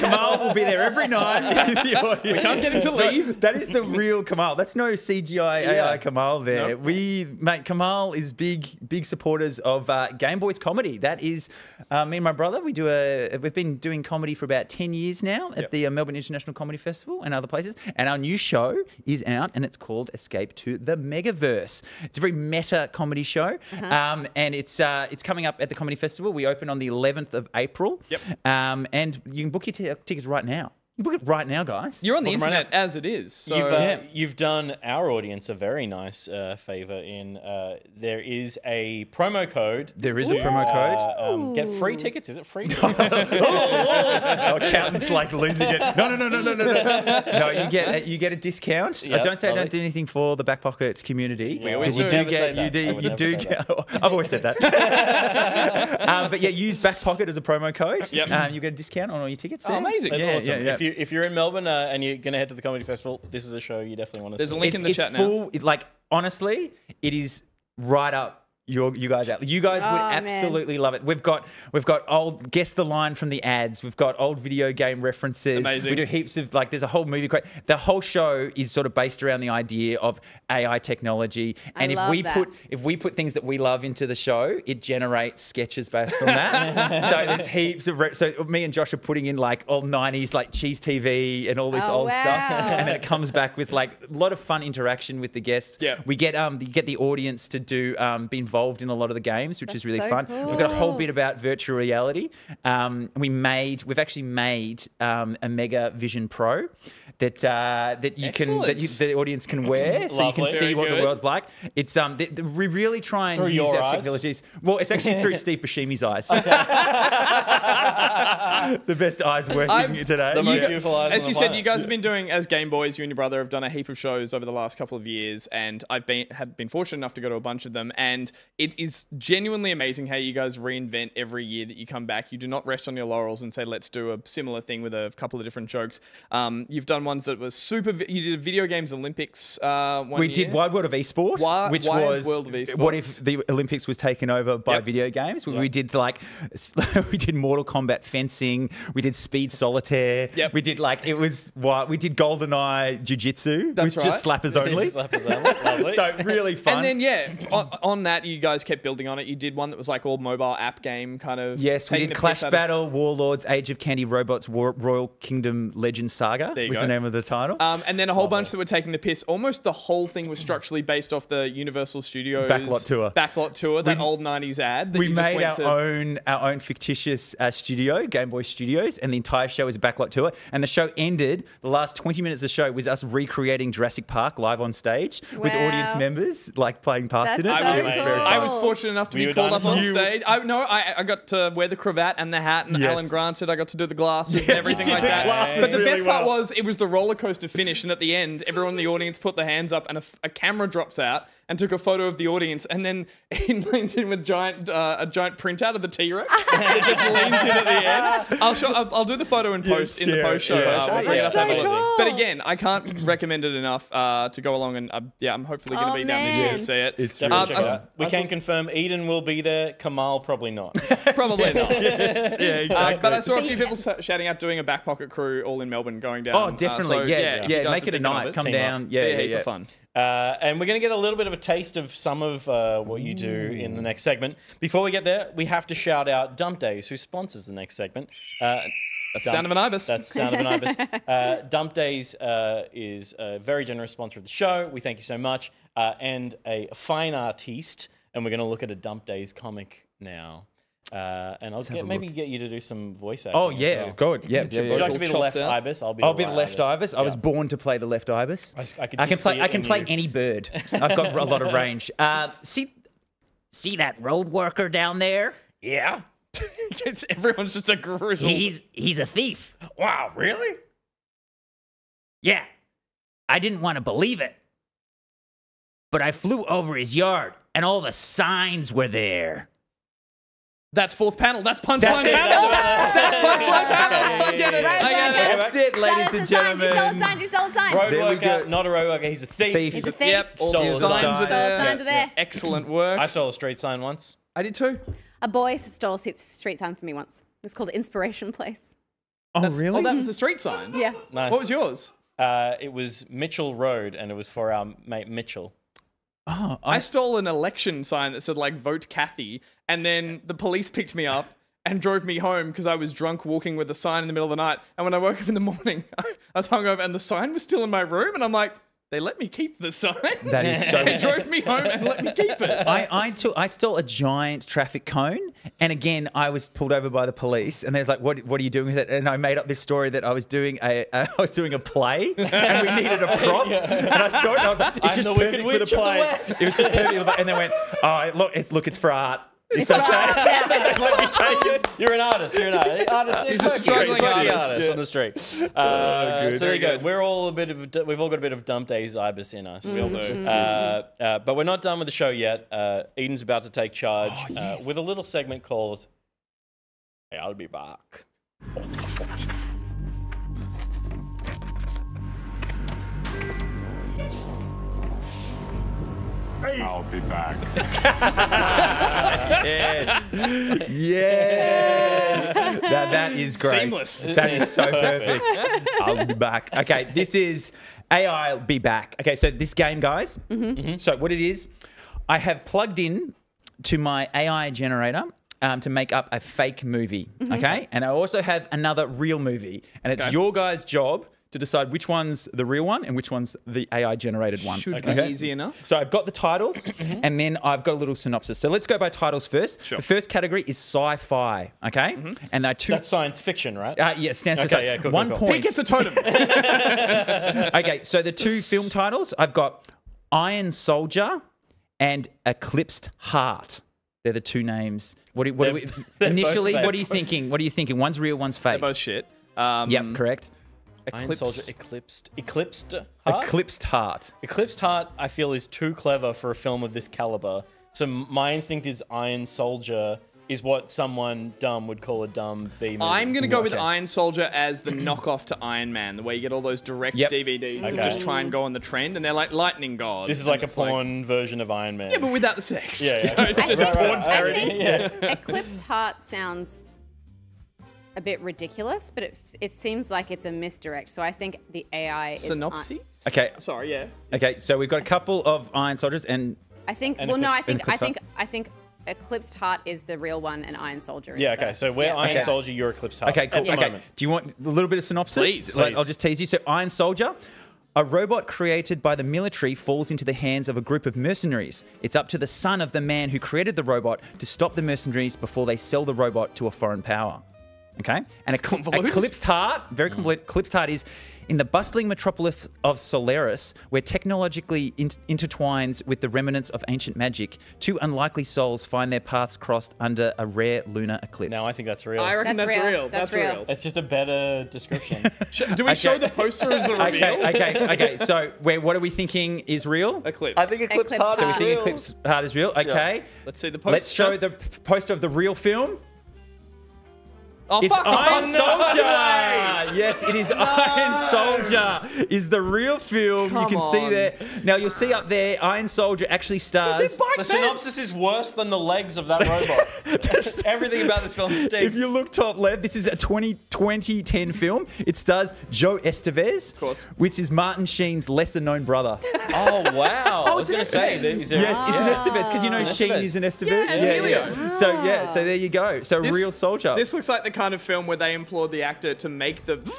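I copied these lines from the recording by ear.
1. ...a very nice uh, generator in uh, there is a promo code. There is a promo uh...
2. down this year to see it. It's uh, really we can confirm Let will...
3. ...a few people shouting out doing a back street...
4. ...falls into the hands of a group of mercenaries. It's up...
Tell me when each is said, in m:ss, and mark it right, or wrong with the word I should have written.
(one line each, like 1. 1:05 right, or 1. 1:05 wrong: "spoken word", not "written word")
1. 0:35 wrong: "favor", not "generator"
2. 3:36 wrong: "Eden", not "Let"
3. 3:43 wrong: "pocket", not "street"
4. 7:49 right.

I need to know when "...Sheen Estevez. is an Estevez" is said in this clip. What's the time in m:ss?
8:52.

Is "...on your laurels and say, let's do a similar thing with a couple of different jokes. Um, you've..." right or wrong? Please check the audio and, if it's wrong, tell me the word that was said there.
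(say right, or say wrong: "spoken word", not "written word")
right.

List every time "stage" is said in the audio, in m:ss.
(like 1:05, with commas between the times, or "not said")
3:04, 3:09.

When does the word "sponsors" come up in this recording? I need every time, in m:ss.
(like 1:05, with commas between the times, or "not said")
3:56, 4:03.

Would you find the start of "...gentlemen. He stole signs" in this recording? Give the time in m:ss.
4:46.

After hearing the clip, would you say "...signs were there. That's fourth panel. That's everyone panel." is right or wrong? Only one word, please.
wrong.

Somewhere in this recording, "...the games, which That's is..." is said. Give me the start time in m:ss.
1:39.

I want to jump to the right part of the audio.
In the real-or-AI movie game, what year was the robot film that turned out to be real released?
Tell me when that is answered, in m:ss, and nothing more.
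8:42.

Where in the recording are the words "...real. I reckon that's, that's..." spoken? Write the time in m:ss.
8:11.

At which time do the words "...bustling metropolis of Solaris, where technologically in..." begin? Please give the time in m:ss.
8:01.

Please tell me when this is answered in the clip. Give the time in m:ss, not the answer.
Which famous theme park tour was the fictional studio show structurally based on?
2:51.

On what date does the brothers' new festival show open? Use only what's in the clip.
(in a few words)
11th of April.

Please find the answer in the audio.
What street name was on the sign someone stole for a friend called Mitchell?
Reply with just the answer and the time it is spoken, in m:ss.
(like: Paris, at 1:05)
Mitchell Road, at 5:03.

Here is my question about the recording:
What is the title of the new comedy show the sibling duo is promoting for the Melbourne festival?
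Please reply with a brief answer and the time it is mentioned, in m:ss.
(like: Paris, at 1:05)
Escape to the Megaverse, at 0:20.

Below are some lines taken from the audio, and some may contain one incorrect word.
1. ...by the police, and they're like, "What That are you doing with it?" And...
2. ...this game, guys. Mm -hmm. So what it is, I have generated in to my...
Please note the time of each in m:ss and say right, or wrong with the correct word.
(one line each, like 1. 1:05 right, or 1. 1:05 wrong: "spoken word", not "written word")
1. 5:26 wrong: "What", not "That"
2. 6:19 wrong: "plugged", not "generated".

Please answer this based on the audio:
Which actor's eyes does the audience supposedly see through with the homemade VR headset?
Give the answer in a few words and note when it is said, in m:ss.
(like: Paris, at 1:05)
Steve Buscemi, at 1:55.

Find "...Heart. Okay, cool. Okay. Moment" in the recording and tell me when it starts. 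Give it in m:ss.
7:42.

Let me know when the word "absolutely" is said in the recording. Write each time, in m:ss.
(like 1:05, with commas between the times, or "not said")
1:10.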